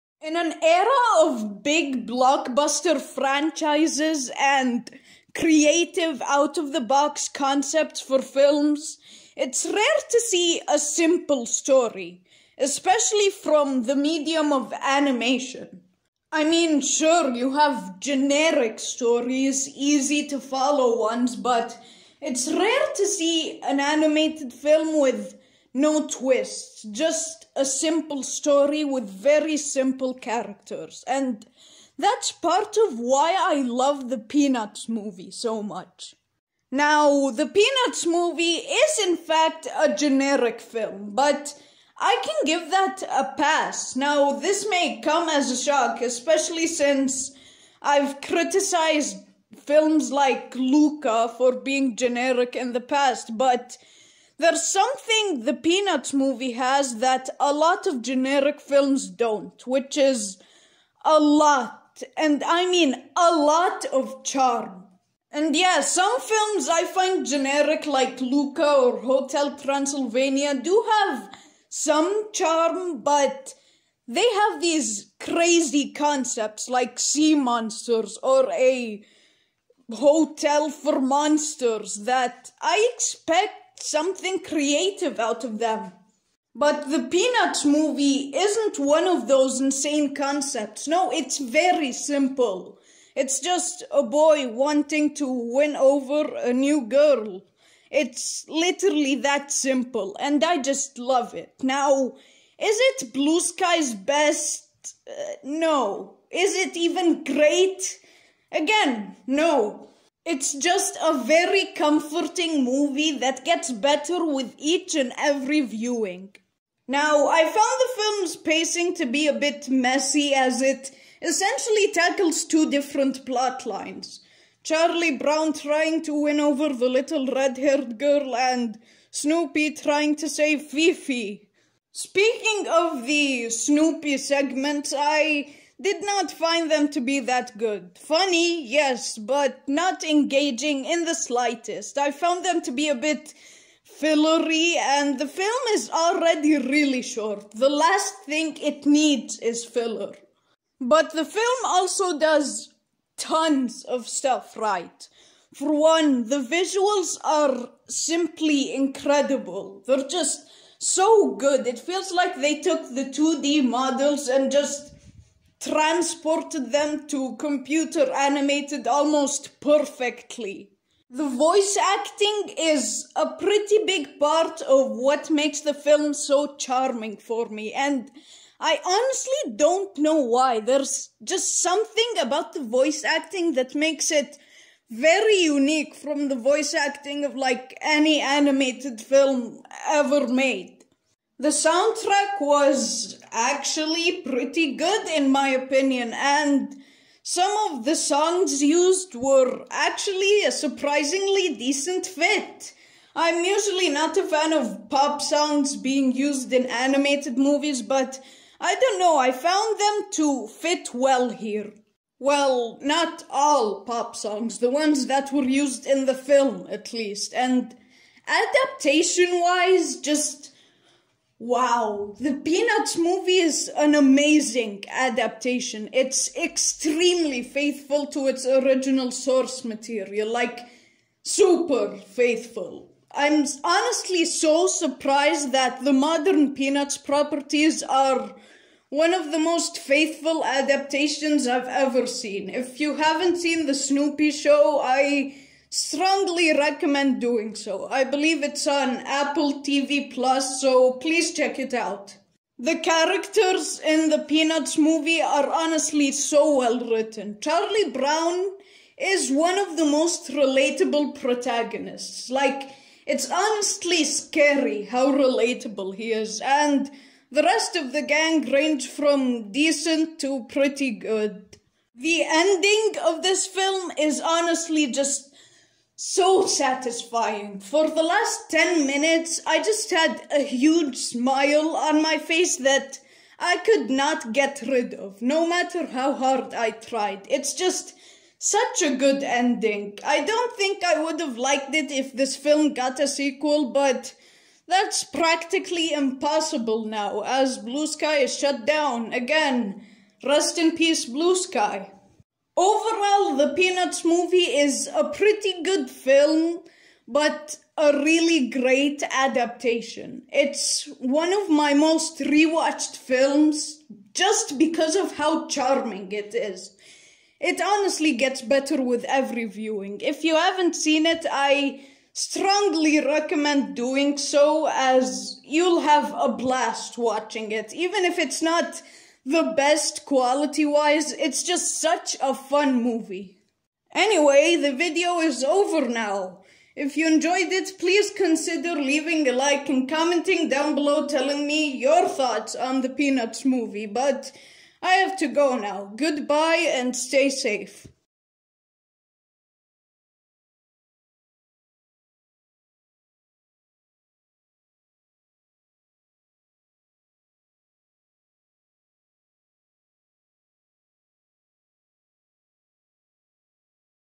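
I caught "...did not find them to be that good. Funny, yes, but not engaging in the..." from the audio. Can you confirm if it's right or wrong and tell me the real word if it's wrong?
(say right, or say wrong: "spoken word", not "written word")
right.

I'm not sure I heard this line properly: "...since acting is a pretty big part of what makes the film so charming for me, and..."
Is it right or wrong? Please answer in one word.
wrong.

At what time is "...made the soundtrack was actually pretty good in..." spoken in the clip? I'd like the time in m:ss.
3:10.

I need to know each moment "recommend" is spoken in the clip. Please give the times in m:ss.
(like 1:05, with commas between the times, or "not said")
4:06, 5:22.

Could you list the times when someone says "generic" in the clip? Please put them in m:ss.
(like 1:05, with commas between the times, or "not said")
0:17, 0:39, 0:51, 0:58, 1:07.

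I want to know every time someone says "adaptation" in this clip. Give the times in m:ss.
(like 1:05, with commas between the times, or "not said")
3:38, 3:44, 4:00, 5:09.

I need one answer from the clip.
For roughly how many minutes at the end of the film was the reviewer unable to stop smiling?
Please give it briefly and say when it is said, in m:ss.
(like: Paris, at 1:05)
10, at 4:38.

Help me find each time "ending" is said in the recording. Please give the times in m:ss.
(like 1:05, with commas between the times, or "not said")
4:32, 4:49.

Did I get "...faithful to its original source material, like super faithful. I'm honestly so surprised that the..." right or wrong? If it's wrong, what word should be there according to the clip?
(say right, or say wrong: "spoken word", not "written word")
right.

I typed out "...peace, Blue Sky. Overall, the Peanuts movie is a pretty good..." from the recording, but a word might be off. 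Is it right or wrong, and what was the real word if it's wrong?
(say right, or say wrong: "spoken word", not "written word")
right.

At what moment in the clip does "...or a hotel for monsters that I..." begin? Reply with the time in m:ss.
1:18.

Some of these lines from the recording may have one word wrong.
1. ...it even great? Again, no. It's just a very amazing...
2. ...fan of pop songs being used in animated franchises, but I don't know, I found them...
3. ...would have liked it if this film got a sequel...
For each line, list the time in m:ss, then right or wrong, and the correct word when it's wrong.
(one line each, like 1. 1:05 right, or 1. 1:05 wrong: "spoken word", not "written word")
1. 1:46 wrong: "comforting", not "amazing"
2. 3:24 wrong: "movies", not "franchises"
3. 4:51 right.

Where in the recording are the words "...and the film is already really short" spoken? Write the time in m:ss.
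2:24.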